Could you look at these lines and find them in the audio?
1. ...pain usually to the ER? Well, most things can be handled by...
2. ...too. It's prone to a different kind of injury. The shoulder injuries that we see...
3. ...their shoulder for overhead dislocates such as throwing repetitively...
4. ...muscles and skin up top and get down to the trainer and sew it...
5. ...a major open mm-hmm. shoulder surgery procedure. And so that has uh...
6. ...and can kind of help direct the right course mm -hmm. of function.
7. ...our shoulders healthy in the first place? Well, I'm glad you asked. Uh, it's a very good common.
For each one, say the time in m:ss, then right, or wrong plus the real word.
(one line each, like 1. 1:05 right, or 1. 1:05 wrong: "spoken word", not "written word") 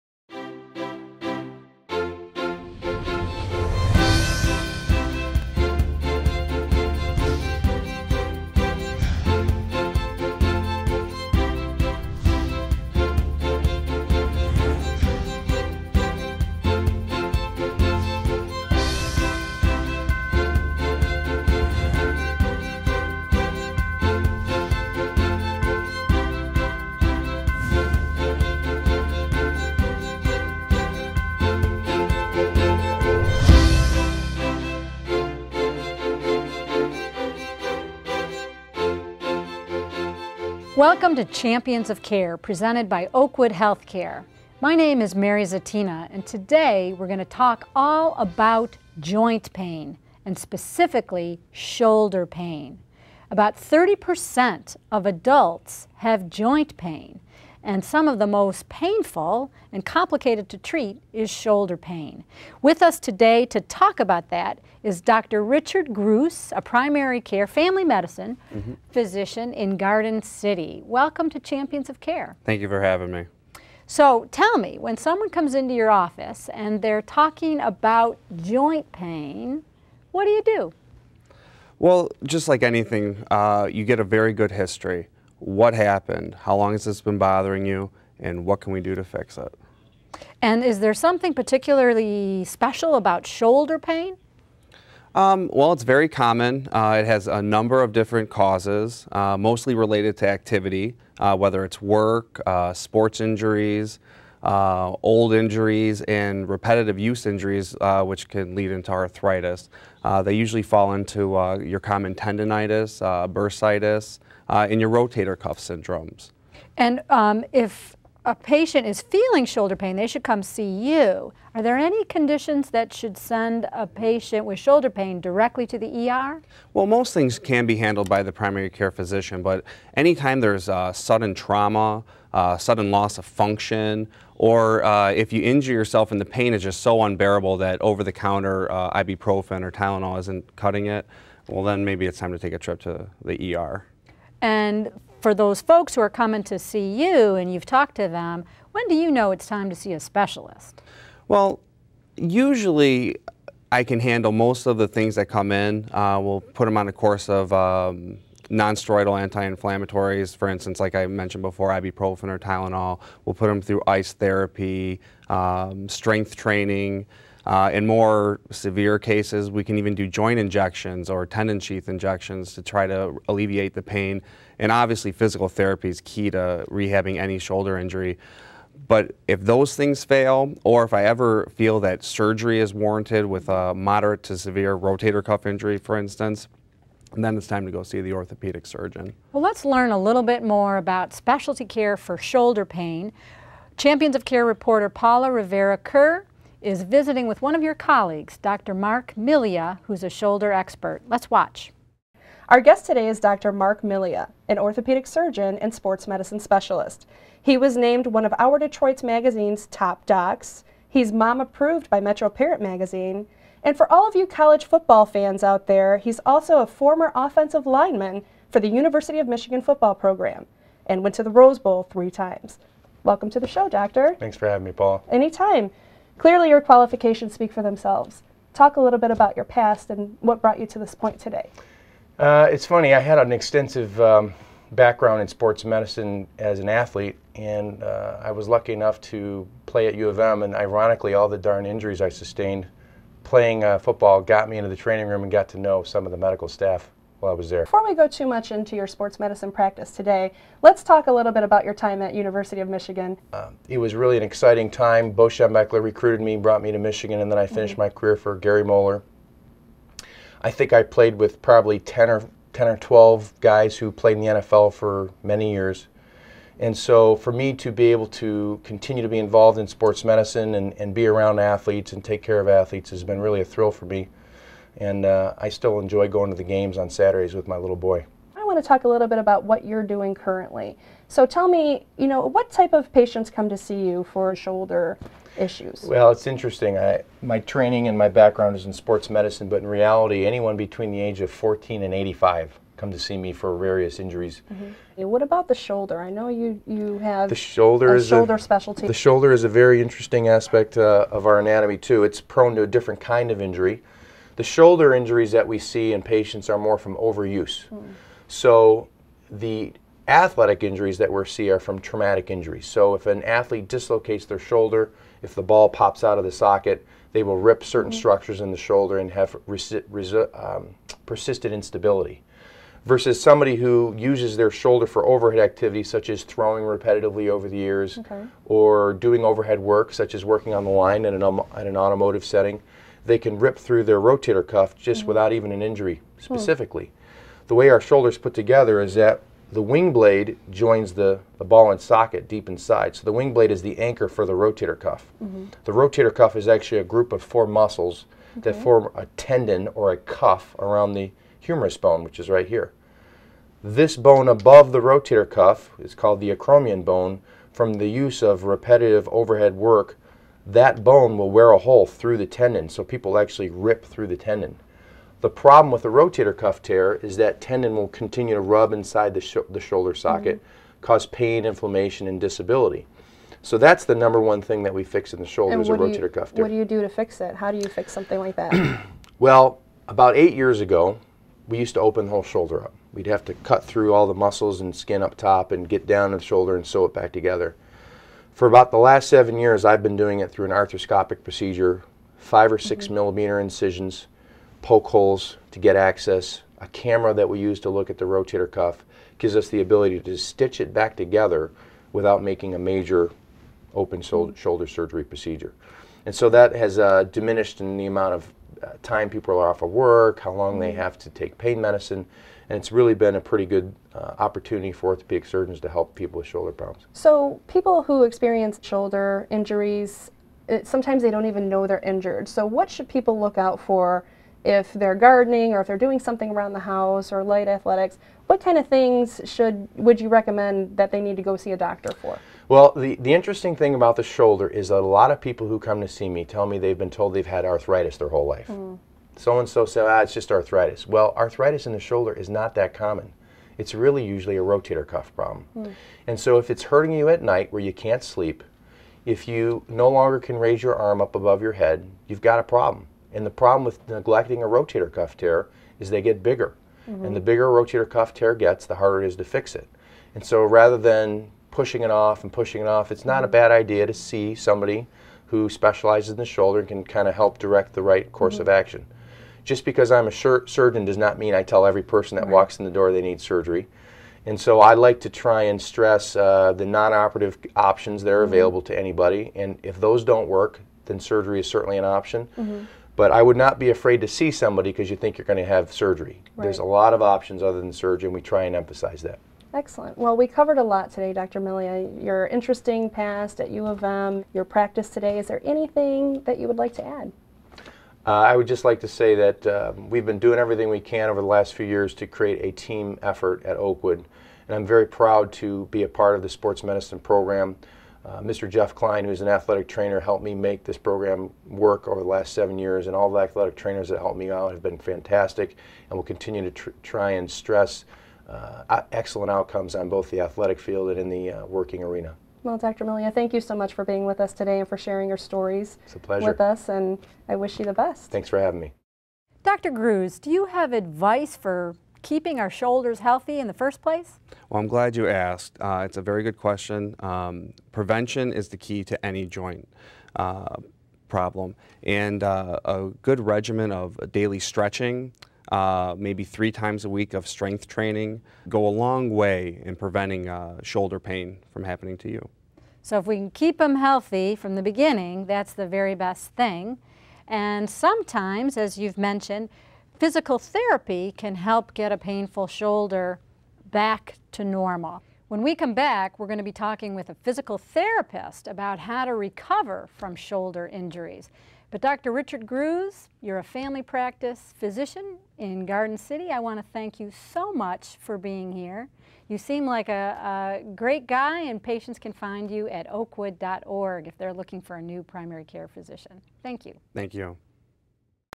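1. 2:04 wrong: "directly", not "usually"
2. 5:01 right
3. 5:24 wrong: "activities", not "dislocates"
4. 6:24 wrong: "shoulder", not "trainer"
5. 6:42 right
6. 7:46 wrong: "action", not "function"
7. 8:52 wrong: "question", not "common".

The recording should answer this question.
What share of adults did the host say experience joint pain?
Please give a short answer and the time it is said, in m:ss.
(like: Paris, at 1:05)
30%, at 0:53.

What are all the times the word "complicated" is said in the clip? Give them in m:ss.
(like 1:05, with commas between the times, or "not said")
0:59.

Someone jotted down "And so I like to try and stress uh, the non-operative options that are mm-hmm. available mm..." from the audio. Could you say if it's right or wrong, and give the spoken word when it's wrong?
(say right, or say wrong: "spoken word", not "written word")
right.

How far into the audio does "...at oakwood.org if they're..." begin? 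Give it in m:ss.
9:42.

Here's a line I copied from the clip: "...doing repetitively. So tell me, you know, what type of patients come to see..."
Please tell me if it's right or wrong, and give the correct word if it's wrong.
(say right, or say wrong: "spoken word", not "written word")
wrong: "currently", not "repetitively".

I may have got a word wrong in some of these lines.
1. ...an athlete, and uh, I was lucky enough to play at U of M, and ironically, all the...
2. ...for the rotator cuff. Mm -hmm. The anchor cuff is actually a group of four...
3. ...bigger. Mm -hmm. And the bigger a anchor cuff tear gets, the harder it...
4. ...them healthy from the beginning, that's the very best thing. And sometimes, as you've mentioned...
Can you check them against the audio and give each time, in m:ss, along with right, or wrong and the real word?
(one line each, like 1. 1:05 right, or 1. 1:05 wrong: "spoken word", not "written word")
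1. 3:56 right
2. 5:44 wrong: "rotator", not "anchor"
3. 7:36 wrong: "rotator", not "anchor"
4. 9:13 right.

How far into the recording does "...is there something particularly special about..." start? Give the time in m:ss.
1:30.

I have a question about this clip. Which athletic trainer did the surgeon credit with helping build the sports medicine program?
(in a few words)
Jeff Klein.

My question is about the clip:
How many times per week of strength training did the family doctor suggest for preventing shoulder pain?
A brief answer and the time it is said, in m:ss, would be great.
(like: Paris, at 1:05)
3, at 9:06.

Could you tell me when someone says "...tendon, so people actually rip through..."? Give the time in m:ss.
6:02.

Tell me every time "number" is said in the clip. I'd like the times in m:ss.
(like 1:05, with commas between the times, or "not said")
1:37, 6:13.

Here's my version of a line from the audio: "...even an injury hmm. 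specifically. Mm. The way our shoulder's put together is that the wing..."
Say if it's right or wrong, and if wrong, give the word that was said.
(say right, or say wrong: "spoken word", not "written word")
right.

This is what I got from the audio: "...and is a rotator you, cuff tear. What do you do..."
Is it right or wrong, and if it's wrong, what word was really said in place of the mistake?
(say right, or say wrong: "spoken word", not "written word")
right.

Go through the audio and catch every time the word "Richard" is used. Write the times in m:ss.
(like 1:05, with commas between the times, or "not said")
1:05, 9:32.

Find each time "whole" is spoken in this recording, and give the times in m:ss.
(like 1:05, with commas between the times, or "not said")
6:22, 7:18.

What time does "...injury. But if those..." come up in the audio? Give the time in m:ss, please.
2:57.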